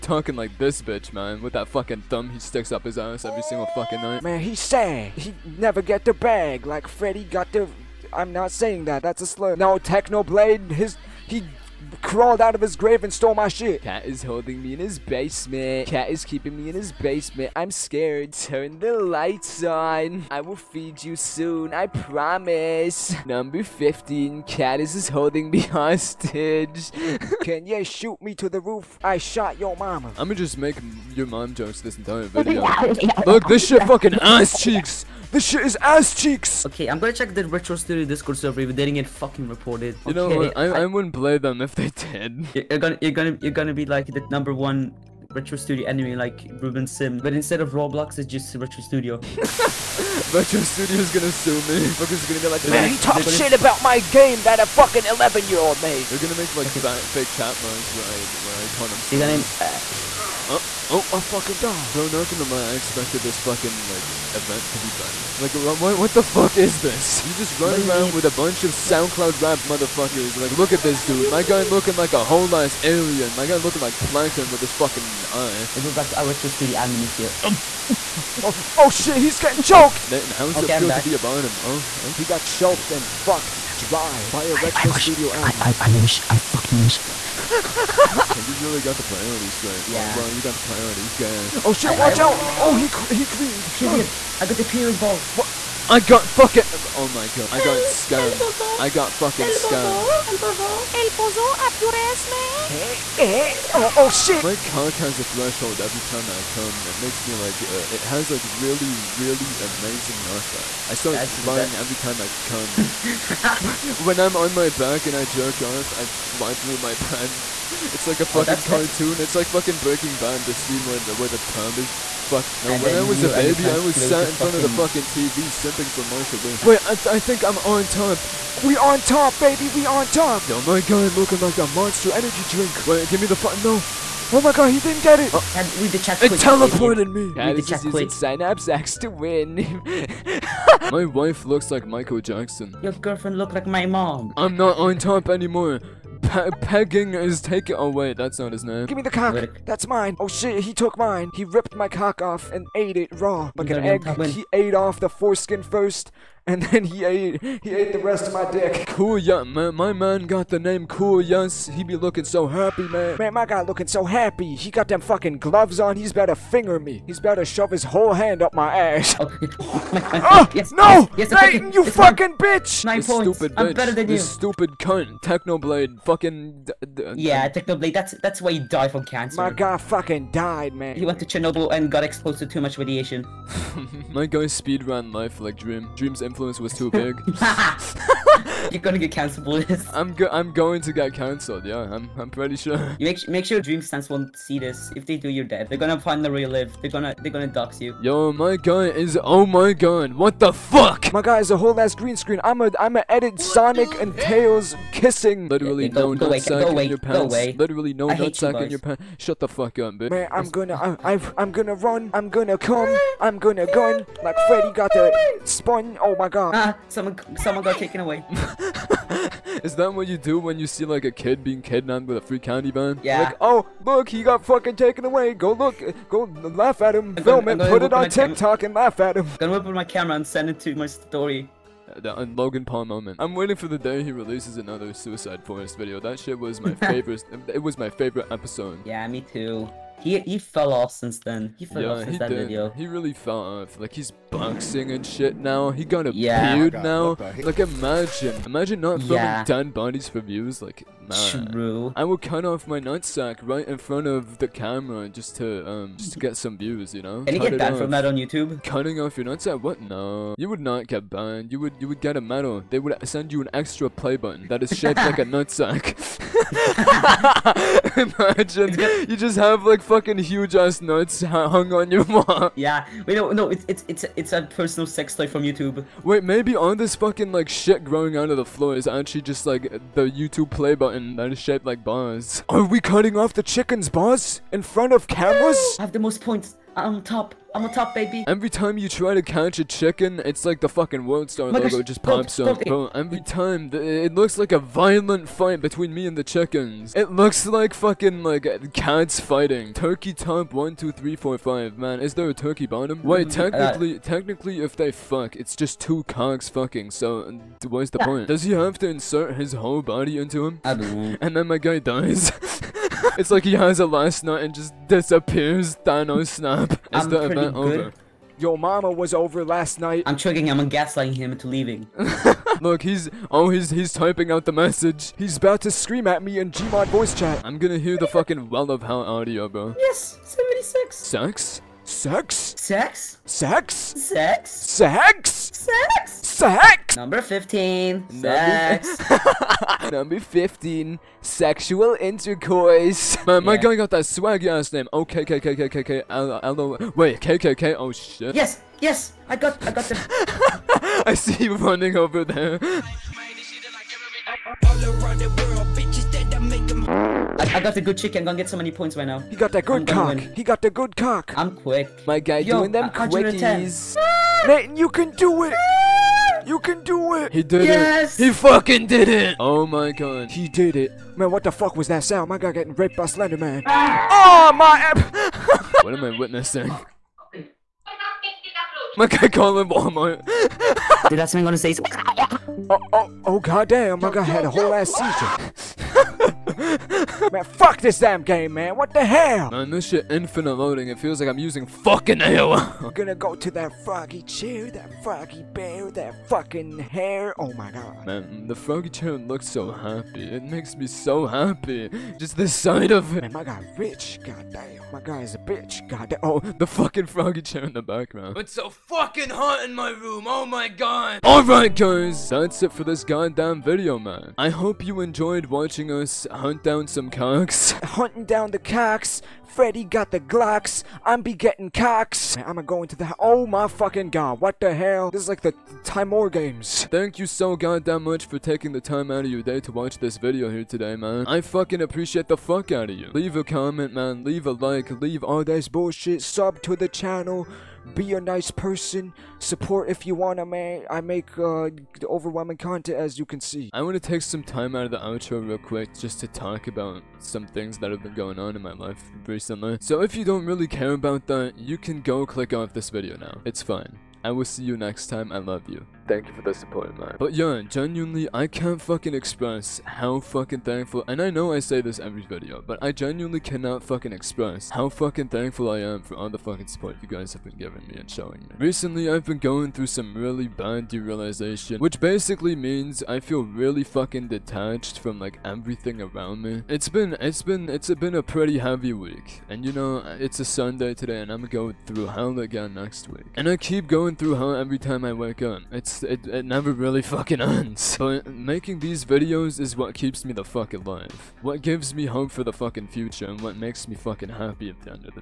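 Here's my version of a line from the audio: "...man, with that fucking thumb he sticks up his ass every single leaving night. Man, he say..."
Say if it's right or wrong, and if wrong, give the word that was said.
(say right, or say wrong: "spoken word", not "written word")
wrong: "fucking", not "leaving".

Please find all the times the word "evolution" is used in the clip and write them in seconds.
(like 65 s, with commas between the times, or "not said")
not said.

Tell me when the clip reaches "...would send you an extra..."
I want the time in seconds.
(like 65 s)
262 s.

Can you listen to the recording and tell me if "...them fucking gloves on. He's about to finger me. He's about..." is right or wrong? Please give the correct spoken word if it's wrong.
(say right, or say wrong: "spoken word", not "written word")
right.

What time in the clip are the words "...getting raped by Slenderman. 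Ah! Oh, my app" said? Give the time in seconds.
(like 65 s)
372 s.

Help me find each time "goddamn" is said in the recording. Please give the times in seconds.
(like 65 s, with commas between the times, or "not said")
383 s, 413 s, 427 s.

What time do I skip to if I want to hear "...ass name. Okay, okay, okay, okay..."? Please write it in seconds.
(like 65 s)
344 s.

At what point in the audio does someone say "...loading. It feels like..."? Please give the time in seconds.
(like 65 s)
390 s.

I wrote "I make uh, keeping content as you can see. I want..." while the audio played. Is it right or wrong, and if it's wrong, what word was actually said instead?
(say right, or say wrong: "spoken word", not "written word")
wrong: "overwhelming", not "keeping".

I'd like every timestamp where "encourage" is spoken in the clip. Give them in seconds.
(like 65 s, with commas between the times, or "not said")
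not said.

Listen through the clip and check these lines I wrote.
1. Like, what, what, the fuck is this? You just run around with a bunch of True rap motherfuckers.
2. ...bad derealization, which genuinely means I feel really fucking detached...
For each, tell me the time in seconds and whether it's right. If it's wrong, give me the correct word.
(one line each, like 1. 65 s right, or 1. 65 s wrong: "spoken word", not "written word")
1. 65 s wrong: "SoundCloud", not "True"
2. 470 s wrong: "basically", not "genuinely".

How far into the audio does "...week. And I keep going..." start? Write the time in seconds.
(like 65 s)
483 s.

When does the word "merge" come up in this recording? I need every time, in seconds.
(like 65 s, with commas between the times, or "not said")
not said.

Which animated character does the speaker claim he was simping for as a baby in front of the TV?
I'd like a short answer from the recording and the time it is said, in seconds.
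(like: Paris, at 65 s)
Marshall Lee, at 126 s.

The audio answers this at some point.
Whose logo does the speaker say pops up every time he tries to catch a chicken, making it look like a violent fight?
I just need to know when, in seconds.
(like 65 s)
291 s.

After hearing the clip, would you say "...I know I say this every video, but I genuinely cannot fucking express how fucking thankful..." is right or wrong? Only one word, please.
right.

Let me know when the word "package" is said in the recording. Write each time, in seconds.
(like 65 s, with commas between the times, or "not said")
not said.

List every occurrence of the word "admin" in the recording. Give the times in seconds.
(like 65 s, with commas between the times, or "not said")
76 s, 85 s.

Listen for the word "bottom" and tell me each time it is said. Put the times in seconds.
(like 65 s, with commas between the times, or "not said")
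81 s, 302 s.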